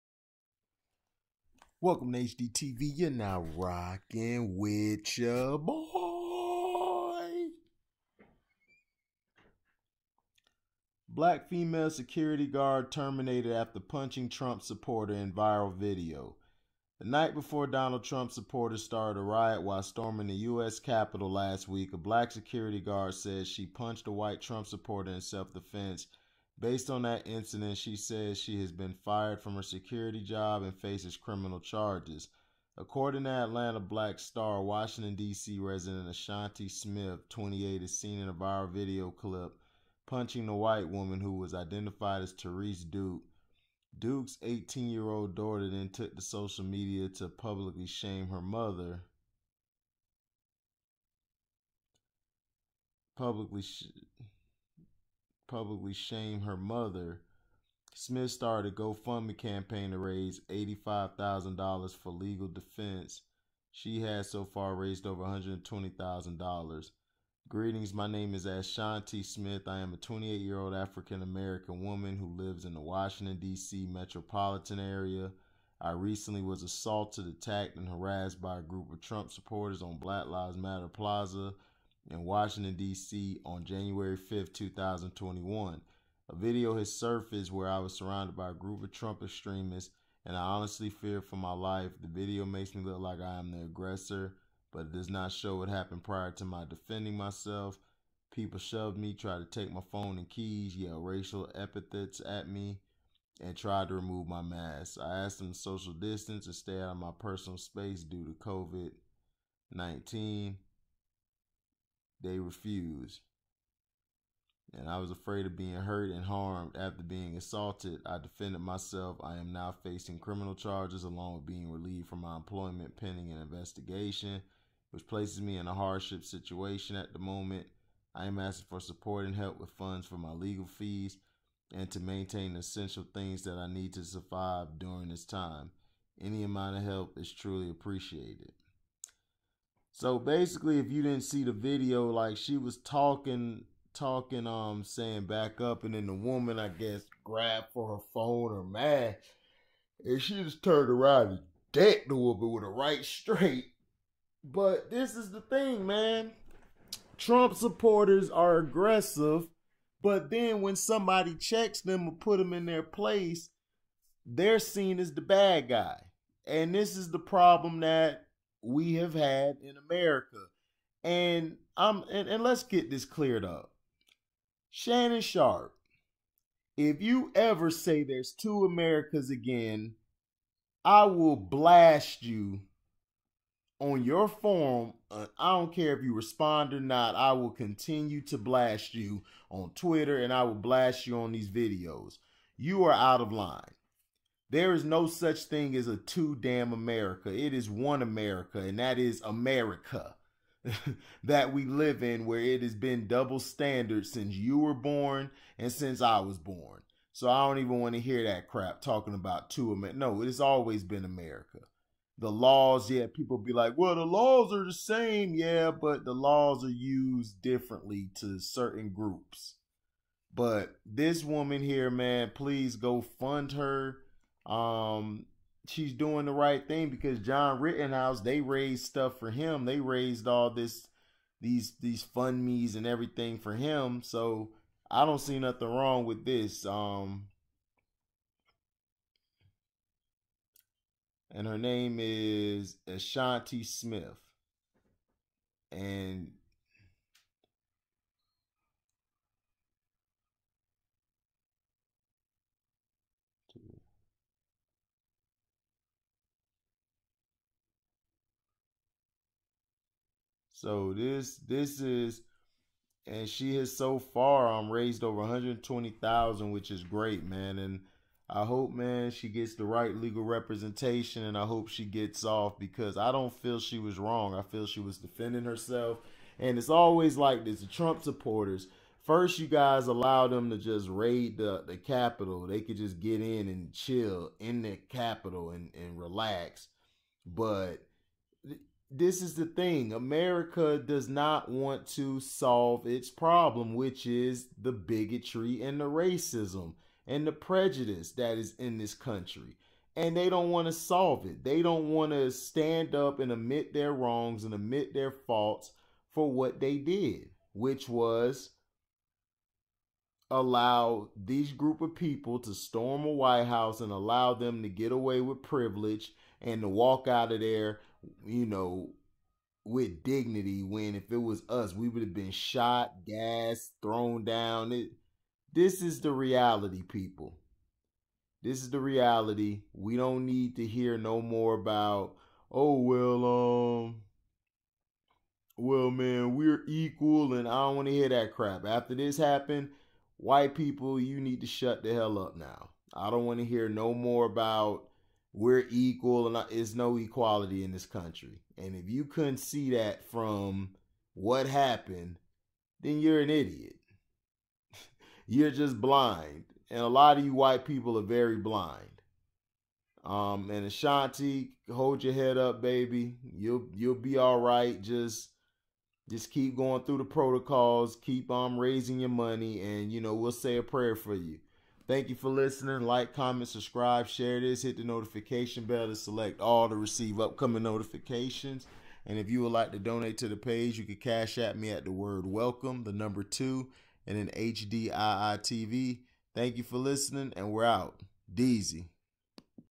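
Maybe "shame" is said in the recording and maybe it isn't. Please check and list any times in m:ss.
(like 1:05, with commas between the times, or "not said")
0:47, 0:55.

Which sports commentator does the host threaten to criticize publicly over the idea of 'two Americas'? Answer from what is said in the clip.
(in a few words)
Shannon Sharpe.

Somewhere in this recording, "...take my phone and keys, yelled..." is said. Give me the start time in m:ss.
1:39.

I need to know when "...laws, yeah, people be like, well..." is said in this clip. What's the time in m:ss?
3:32.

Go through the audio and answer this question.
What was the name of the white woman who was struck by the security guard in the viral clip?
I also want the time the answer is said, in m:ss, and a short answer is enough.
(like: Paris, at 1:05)
Therese Duke, at 0:42.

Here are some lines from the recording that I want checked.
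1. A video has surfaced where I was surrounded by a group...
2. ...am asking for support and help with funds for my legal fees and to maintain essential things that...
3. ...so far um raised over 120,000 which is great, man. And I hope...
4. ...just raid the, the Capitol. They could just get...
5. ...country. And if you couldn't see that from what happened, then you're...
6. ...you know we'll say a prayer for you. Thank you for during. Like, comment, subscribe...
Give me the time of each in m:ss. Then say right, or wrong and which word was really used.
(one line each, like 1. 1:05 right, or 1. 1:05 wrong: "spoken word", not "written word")
1. 1:26 right
2. 2:08 right
3. 4:23 right
4. 4:40 right
5. 5:47 right
6. 6:09 wrong: "listening", not "during".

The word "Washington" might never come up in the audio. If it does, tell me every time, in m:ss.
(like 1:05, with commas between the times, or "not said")
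0:34, 1:12, 1:22.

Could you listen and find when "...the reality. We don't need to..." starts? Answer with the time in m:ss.
5:28.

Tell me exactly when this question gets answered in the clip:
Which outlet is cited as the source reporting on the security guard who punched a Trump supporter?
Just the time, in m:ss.
0:33.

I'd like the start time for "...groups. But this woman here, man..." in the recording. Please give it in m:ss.
3:38.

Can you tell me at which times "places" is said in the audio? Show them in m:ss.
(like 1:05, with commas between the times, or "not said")
2:05, 2:42.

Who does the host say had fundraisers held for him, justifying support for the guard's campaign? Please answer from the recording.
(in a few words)
John Rittenhouse.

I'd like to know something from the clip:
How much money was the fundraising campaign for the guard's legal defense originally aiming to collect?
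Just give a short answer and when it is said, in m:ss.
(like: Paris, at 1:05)
$85,000, at 1:00.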